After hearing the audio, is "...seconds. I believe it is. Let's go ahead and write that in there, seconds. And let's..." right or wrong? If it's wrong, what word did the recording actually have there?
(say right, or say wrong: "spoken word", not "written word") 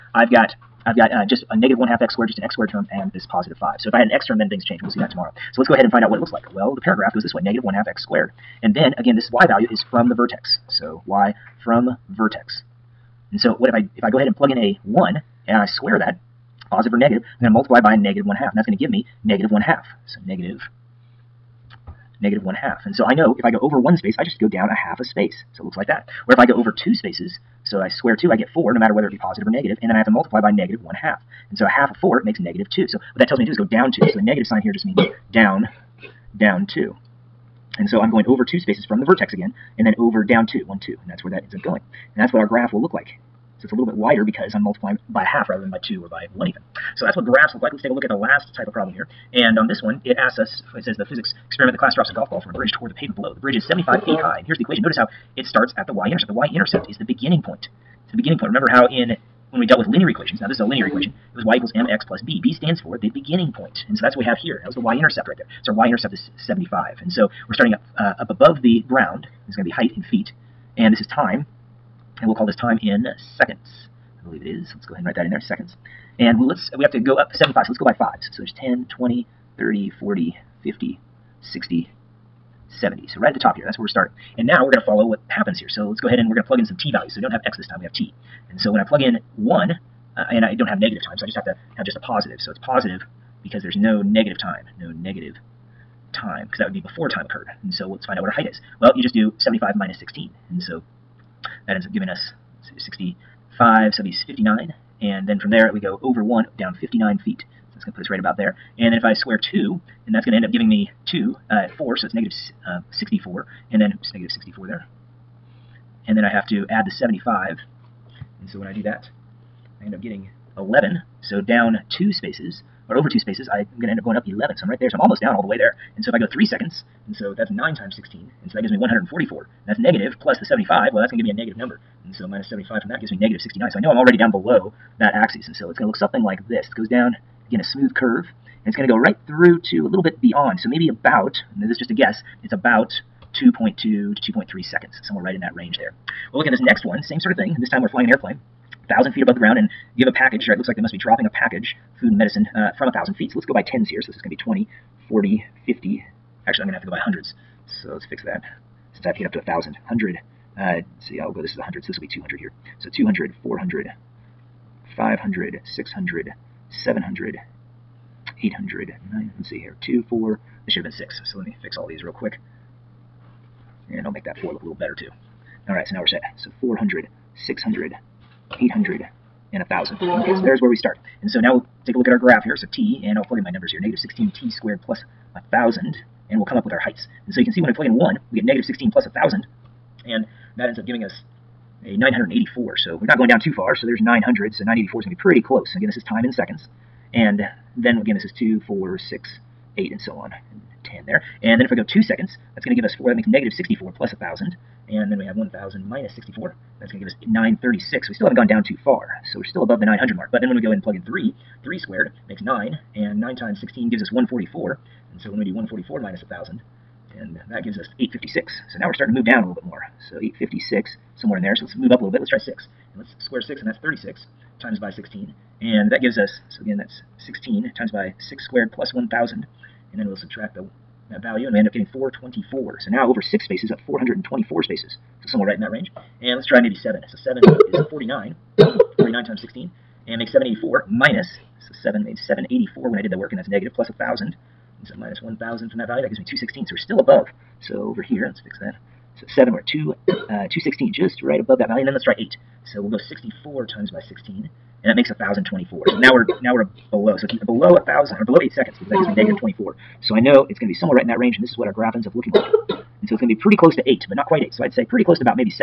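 right.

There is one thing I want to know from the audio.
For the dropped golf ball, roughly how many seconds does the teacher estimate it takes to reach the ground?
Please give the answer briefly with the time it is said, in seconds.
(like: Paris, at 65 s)
2.2 to 2.3 seconds, at 143 s.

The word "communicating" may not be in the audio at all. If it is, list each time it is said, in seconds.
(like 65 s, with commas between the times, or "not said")
not said.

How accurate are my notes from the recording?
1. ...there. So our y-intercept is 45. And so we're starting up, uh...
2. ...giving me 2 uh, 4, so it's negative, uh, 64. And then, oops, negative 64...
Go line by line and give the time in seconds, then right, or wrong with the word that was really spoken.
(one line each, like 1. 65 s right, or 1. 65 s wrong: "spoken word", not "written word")
1. 65 s wrong: "75", not "45"
2. 110 s right.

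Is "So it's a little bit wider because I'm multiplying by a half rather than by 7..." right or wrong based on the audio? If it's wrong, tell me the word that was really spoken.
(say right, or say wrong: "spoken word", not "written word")
wrong: "2", not "7".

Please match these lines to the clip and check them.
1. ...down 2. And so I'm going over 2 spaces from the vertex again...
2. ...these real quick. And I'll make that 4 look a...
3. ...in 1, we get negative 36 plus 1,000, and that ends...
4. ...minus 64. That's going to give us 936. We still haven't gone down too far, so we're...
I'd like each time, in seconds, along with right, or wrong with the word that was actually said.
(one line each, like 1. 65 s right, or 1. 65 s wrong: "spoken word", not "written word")
1. 36 s right
2. 171 s right
3. 187 s wrong: "16", not "36"
4. 205 s right.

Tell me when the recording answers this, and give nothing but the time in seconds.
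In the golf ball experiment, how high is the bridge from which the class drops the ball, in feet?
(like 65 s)
53 s.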